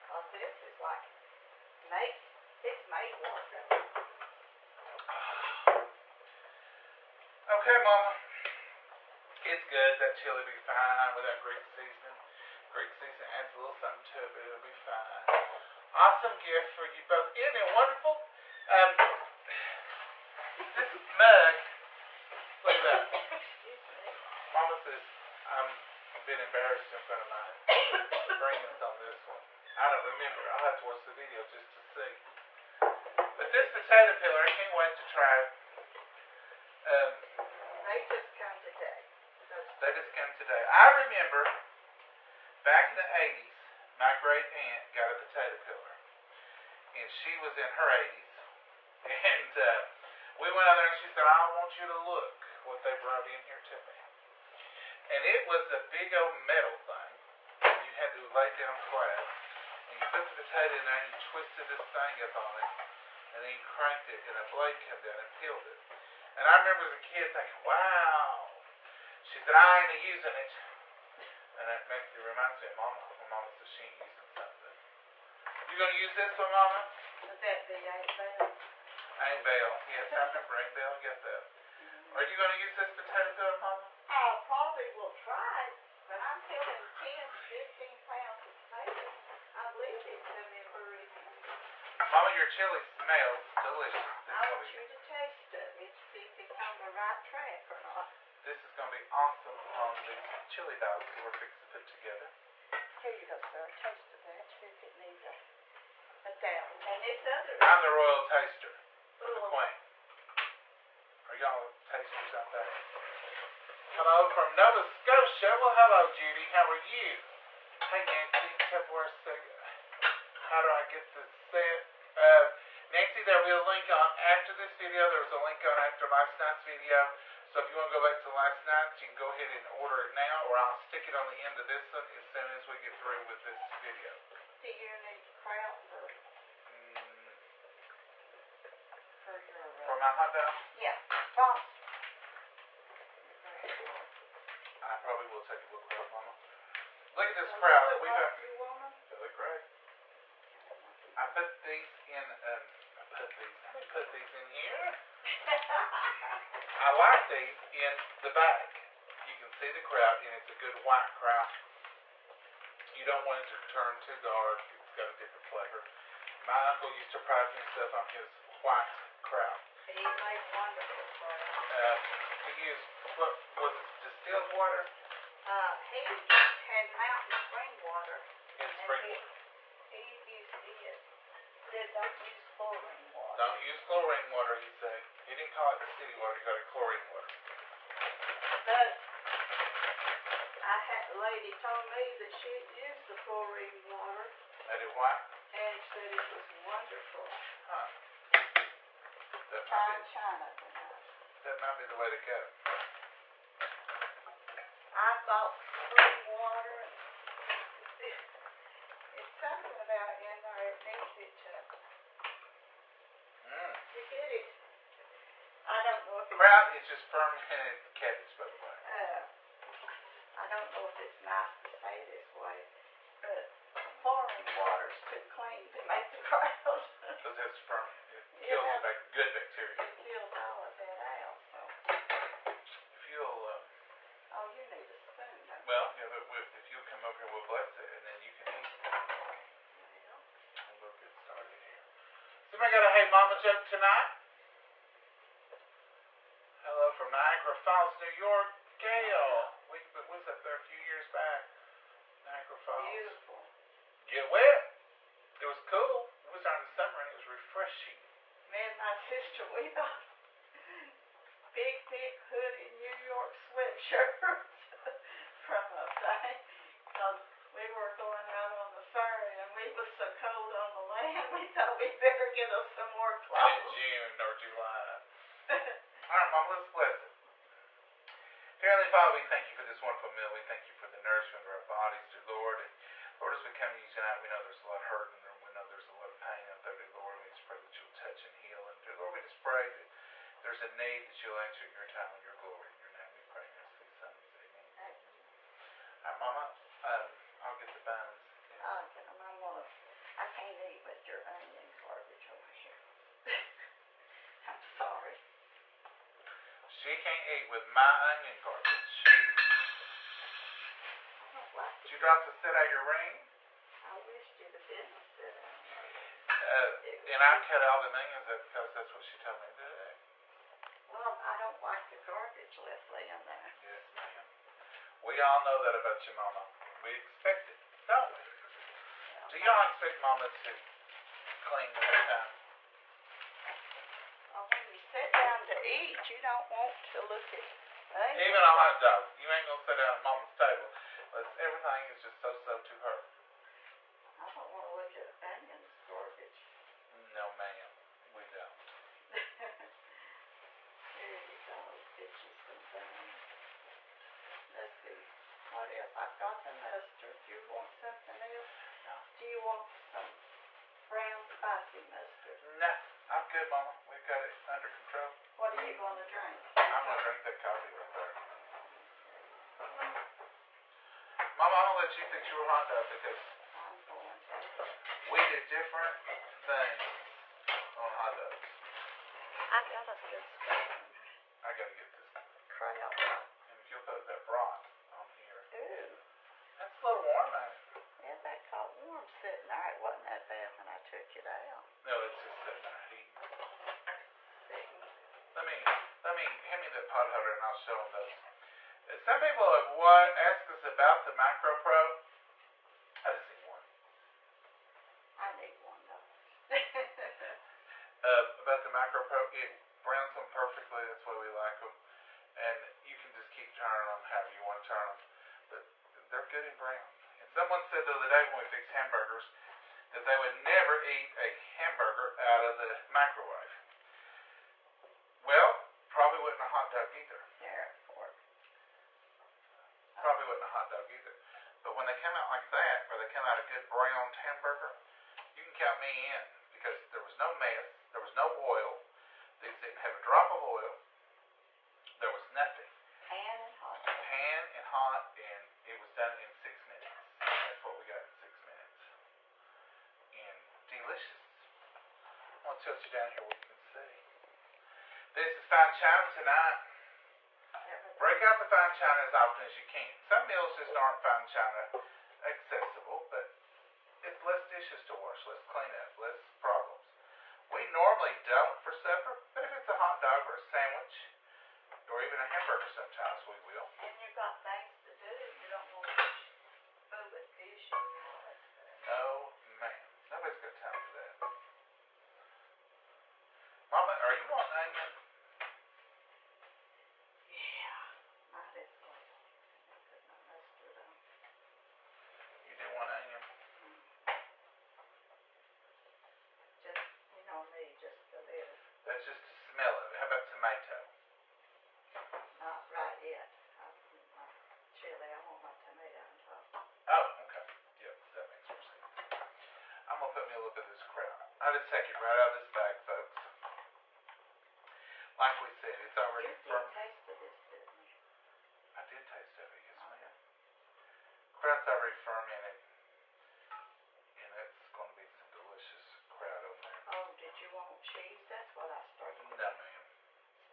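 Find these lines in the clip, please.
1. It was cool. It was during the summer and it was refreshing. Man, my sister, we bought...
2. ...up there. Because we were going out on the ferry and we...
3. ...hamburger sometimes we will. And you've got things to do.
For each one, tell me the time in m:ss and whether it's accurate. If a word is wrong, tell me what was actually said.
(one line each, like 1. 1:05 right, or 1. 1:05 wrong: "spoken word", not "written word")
1. 4:15 right
2. 4:25 right
3. 7:52 right.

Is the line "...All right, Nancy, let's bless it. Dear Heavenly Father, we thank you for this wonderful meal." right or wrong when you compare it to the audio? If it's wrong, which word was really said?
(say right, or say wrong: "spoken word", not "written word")
wrong: "Mom", not "Nancy".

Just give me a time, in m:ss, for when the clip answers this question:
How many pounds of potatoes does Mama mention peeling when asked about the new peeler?
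1:26.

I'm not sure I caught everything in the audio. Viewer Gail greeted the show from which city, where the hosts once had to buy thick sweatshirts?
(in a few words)
Niagara Falls, New York.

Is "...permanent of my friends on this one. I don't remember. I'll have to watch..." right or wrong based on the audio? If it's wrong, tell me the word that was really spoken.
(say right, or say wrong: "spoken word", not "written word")
wrong: "front", not "permanent".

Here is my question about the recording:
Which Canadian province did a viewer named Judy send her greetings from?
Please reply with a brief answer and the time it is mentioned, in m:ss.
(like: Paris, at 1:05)
Nova Scotia, at 1:54.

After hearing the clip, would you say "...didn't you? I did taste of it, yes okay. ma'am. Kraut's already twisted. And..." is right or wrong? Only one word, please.
wrong.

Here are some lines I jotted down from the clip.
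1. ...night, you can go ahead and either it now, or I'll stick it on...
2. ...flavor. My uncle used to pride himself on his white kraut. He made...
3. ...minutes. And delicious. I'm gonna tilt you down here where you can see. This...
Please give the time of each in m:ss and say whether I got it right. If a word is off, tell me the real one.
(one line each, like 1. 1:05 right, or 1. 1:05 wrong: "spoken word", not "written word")
1. 2:08 wrong: "order", not "either"
2. 2:45 right
3. 7:28 right.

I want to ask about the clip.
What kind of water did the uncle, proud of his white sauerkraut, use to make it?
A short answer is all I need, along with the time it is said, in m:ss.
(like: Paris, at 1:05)
mountain spring water, at 2:56.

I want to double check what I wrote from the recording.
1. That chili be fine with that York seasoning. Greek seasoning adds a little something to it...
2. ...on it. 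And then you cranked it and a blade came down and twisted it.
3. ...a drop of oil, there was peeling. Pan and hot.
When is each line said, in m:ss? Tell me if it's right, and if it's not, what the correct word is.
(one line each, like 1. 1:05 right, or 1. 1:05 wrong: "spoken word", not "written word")
1. 0:09 wrong: "Greek", not "York"
2. 1:02 wrong: "peeled", not "twisted"
3. 7:19 wrong: "nothing", not "peeling".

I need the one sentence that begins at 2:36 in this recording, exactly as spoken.
I like these in the back.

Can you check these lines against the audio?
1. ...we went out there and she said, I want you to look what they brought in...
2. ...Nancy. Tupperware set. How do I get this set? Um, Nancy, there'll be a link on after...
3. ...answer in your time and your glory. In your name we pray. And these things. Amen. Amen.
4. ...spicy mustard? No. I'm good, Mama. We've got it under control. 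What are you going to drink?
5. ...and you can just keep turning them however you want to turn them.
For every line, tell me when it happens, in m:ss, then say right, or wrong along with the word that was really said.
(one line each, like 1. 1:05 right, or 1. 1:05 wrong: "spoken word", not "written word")
1. 0:50 right
2. 1:58 right
3. 4:51 right
4. 6:01 right
5. 6:52 right.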